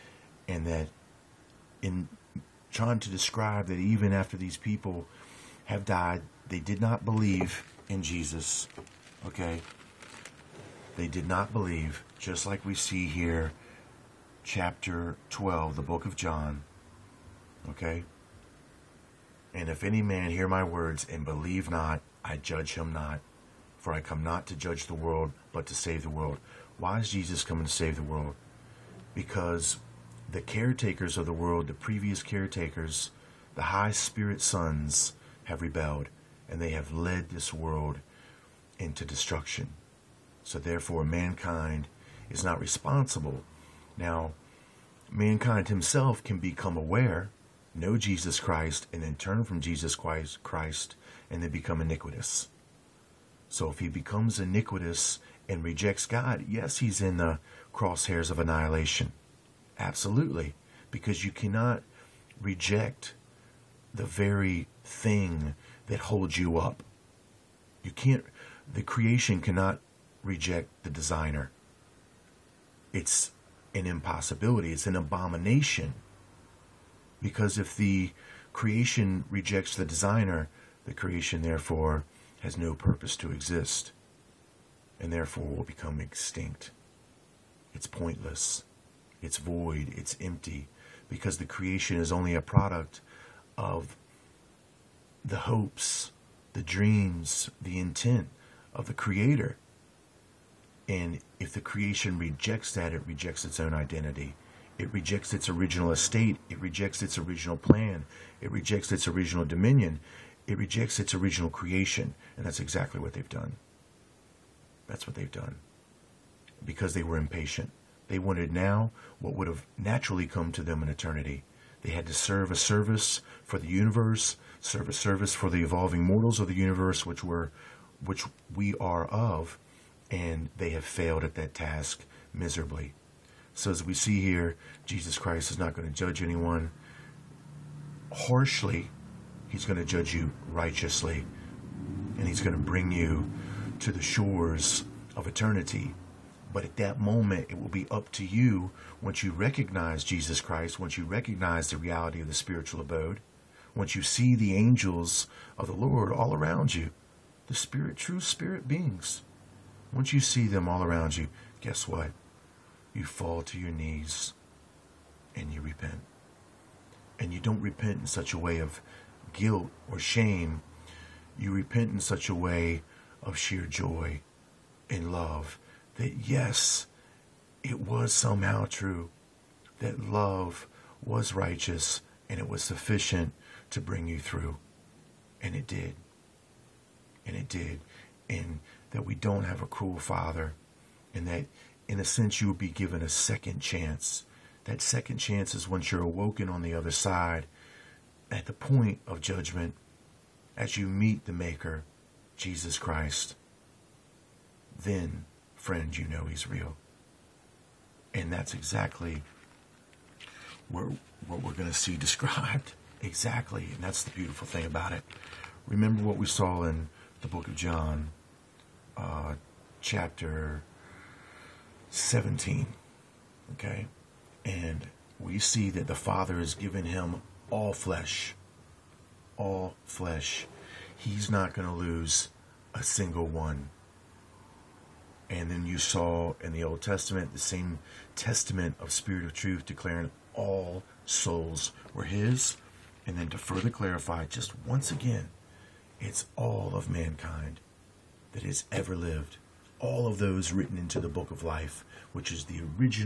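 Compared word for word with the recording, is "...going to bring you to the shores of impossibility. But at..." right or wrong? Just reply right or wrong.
wrong.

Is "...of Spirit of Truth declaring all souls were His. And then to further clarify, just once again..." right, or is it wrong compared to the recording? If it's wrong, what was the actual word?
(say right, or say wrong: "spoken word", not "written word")
right.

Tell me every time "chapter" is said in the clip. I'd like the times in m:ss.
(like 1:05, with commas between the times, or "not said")
0:14, 3:39.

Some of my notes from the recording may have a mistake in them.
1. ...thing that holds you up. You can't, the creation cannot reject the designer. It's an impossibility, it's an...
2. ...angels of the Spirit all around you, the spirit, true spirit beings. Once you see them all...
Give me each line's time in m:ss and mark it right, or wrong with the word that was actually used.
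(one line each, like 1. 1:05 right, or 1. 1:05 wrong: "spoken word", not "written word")
1. 1:04 right
2. 2:34 wrong: "Lord", not "Spirit".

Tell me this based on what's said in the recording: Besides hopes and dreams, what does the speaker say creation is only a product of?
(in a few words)
intent.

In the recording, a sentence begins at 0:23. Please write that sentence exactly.
For I come not to judge the world, but to save the world.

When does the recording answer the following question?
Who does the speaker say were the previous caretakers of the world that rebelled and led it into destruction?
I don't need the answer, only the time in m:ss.
0:33.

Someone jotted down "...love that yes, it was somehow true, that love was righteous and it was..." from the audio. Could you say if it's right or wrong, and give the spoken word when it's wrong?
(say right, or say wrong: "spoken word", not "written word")
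right.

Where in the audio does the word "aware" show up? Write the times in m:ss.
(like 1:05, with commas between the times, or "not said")
0:46.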